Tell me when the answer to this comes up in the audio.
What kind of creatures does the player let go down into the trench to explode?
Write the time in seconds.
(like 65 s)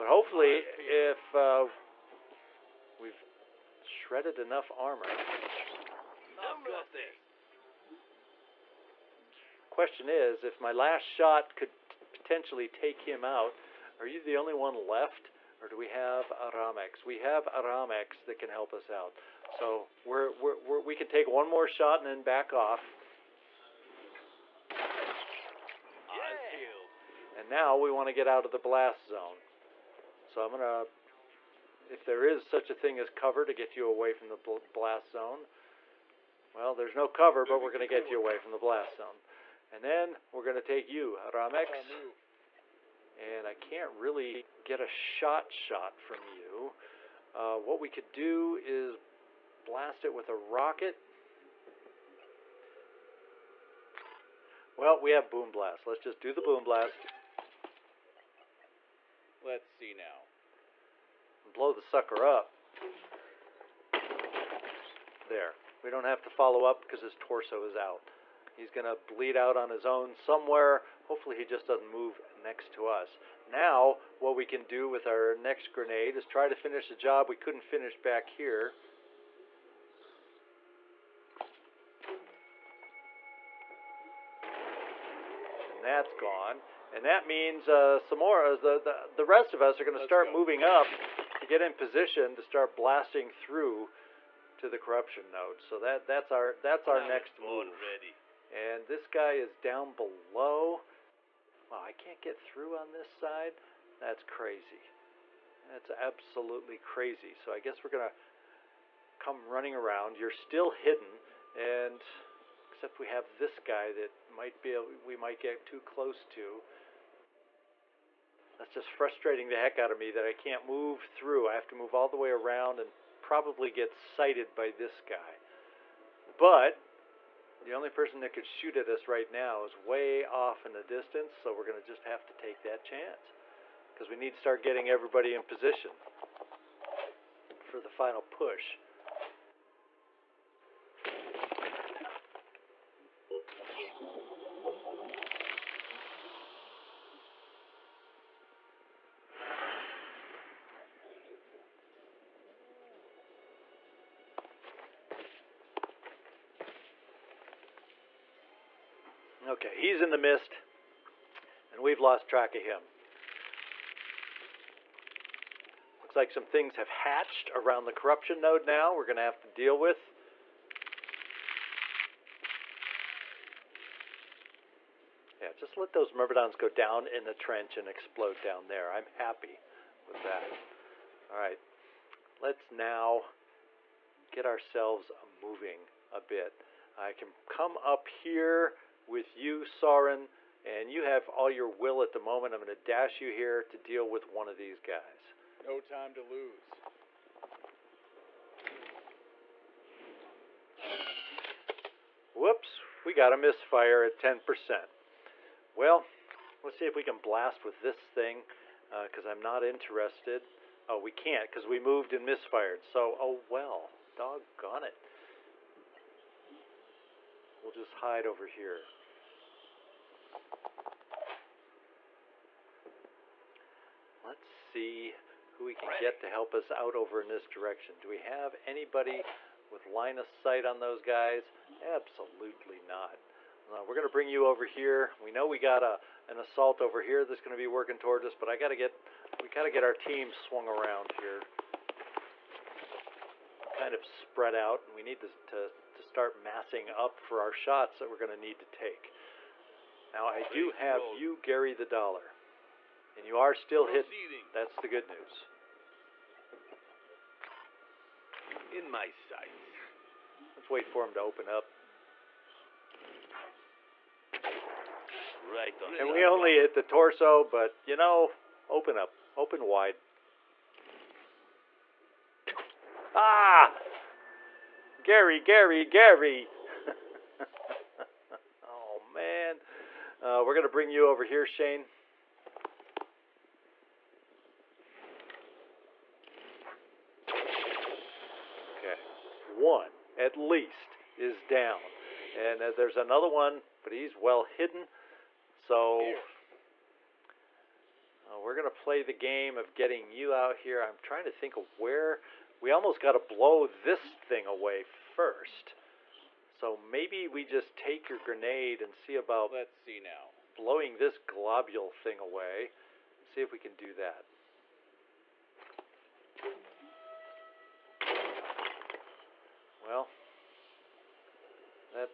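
176 s.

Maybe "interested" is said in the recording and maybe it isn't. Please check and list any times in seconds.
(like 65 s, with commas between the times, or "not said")
209 s.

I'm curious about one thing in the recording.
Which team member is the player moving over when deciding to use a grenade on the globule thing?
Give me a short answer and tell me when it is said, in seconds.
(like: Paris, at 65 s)
Shane, at 281 s.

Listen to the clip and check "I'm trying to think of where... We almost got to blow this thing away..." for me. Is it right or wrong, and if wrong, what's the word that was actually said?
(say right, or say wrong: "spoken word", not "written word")
right.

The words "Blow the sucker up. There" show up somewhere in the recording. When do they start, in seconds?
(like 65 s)
61 s.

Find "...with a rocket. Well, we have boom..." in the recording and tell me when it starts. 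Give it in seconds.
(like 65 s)
50 s.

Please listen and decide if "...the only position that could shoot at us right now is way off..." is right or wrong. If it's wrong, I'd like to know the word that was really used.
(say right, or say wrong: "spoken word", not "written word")
wrong: "person", not "position".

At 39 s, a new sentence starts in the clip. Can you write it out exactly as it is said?
And then we're going to take you, Ramex and I can't really get a shot shot from you.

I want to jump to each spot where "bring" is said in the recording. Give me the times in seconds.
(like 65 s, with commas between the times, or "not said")
234 s, 280 s.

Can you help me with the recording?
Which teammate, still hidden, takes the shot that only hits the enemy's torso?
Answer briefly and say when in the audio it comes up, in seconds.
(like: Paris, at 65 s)
Gary the Dollar, at 251 s.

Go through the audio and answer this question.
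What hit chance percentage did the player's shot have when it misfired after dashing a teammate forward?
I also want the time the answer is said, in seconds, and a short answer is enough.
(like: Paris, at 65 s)
10%, at 204 s.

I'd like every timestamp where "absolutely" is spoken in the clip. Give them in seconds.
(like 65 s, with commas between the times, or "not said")
105 s, 231 s.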